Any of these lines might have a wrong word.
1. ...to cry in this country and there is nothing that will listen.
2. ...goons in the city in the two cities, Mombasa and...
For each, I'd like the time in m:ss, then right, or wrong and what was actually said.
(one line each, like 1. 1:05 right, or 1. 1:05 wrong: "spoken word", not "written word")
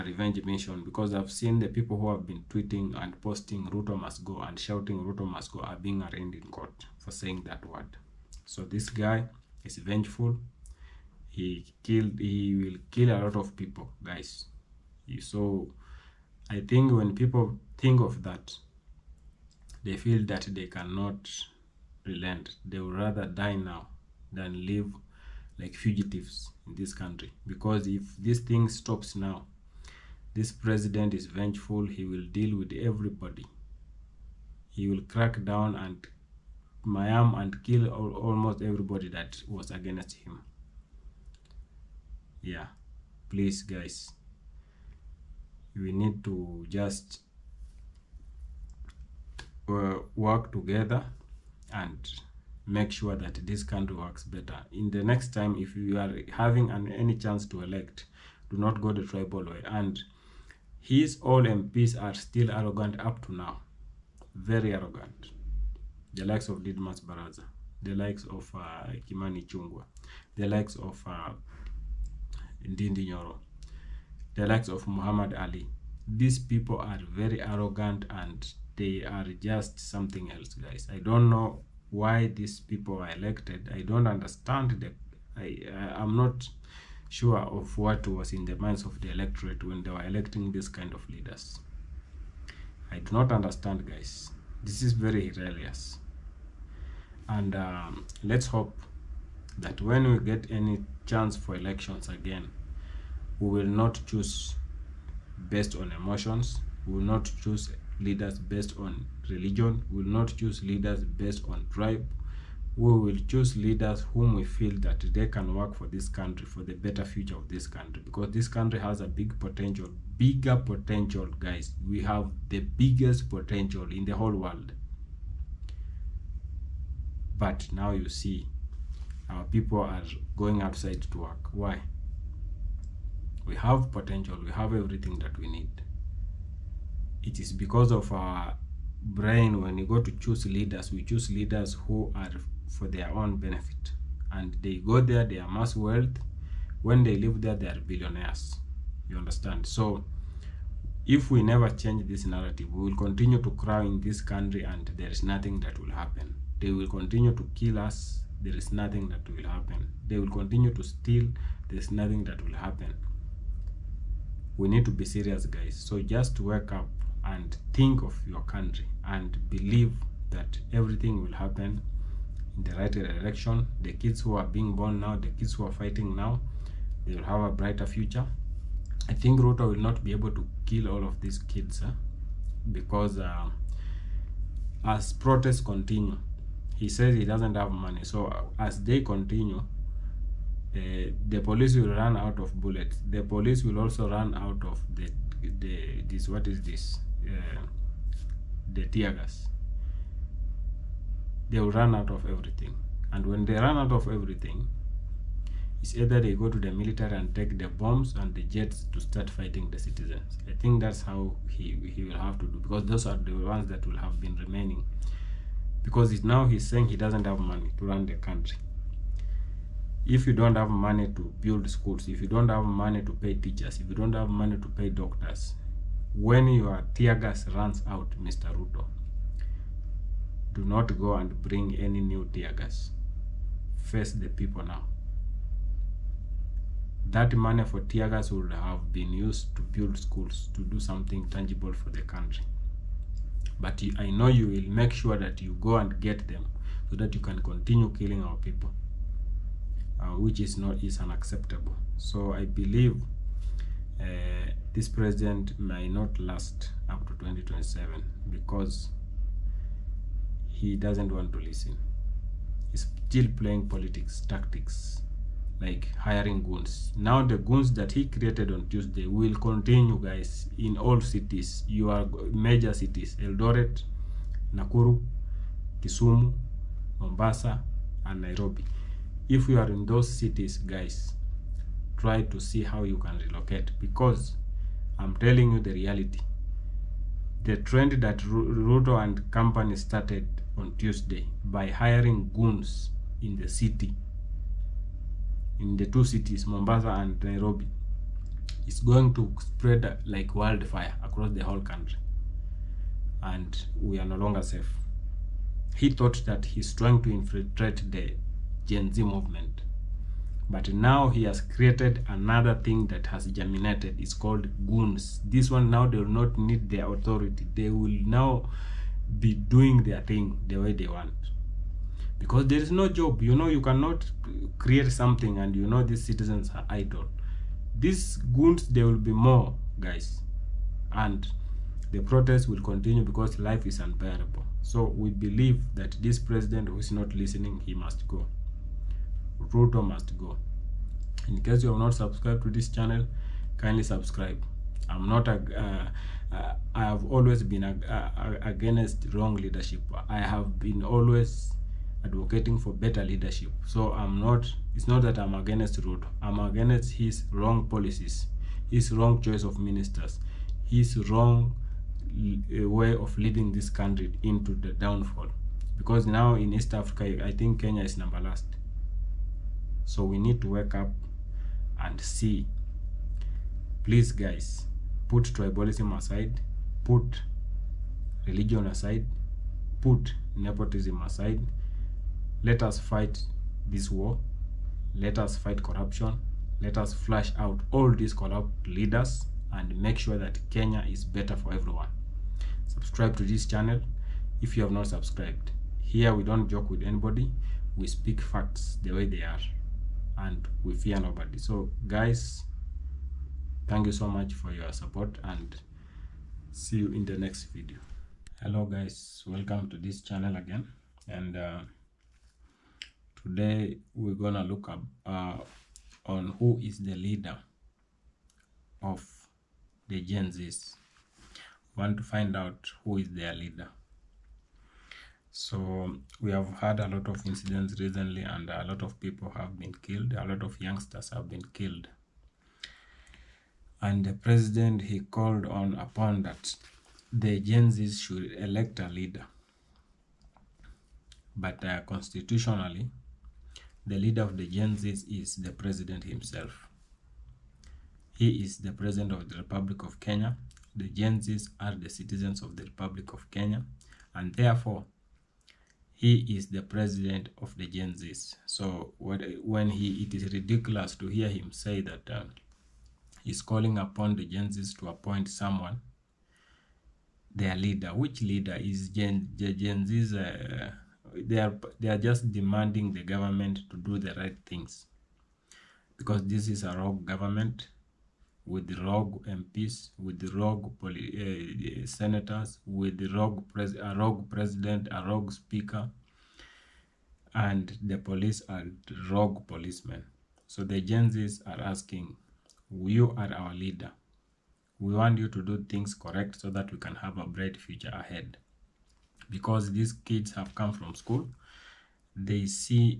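1. 2:33 wrong: "happen", not "listen"
2. 4:52 right.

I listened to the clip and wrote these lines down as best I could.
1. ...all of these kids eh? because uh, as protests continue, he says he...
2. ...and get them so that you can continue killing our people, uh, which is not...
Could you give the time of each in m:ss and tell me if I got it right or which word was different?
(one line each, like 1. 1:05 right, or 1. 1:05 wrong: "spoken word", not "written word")
1. 3:00 right
2. 4:05 right.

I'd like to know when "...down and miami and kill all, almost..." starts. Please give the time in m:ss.
0:35.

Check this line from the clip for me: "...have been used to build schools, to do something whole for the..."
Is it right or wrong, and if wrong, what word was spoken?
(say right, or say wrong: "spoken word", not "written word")
wrong: "tangible", not "whole".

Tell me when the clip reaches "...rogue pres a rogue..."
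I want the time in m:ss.
8:03.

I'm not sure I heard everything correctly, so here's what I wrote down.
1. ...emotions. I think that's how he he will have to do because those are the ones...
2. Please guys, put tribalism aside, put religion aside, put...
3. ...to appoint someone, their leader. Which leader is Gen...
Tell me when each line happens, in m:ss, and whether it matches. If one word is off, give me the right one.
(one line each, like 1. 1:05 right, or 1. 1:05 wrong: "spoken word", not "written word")
1. 3:29 wrong: "citizens", not "emotions"
2. 6:13 right
3. 7:44 right.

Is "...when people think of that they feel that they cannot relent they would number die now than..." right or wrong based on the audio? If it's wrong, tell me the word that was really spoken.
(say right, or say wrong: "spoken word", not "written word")
wrong: "rather", not "number".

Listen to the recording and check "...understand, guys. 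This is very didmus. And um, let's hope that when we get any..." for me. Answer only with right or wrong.
wrong.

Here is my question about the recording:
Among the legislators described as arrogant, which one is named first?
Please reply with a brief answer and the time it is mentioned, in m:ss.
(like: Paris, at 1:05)
Didmus Barasa, at 1:06.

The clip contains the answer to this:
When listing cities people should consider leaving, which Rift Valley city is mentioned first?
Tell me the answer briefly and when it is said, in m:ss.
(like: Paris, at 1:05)
Eldoret, at 4:33.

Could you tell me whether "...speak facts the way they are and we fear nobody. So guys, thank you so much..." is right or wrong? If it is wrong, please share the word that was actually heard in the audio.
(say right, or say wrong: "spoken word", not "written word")
right.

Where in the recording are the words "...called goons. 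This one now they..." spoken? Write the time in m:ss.
5:14.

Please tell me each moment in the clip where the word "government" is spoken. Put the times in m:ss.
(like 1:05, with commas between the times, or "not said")
7:53, 7:57.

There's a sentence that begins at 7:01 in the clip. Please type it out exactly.
Want to find out who is their leader.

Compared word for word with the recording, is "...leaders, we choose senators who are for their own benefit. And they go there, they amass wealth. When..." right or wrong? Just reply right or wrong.
wrong.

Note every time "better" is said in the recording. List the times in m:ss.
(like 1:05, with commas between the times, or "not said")
0:54, 1:56, 5:52, 6:31.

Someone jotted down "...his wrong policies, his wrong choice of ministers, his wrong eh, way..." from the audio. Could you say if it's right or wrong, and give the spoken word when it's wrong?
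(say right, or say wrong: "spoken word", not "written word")
right.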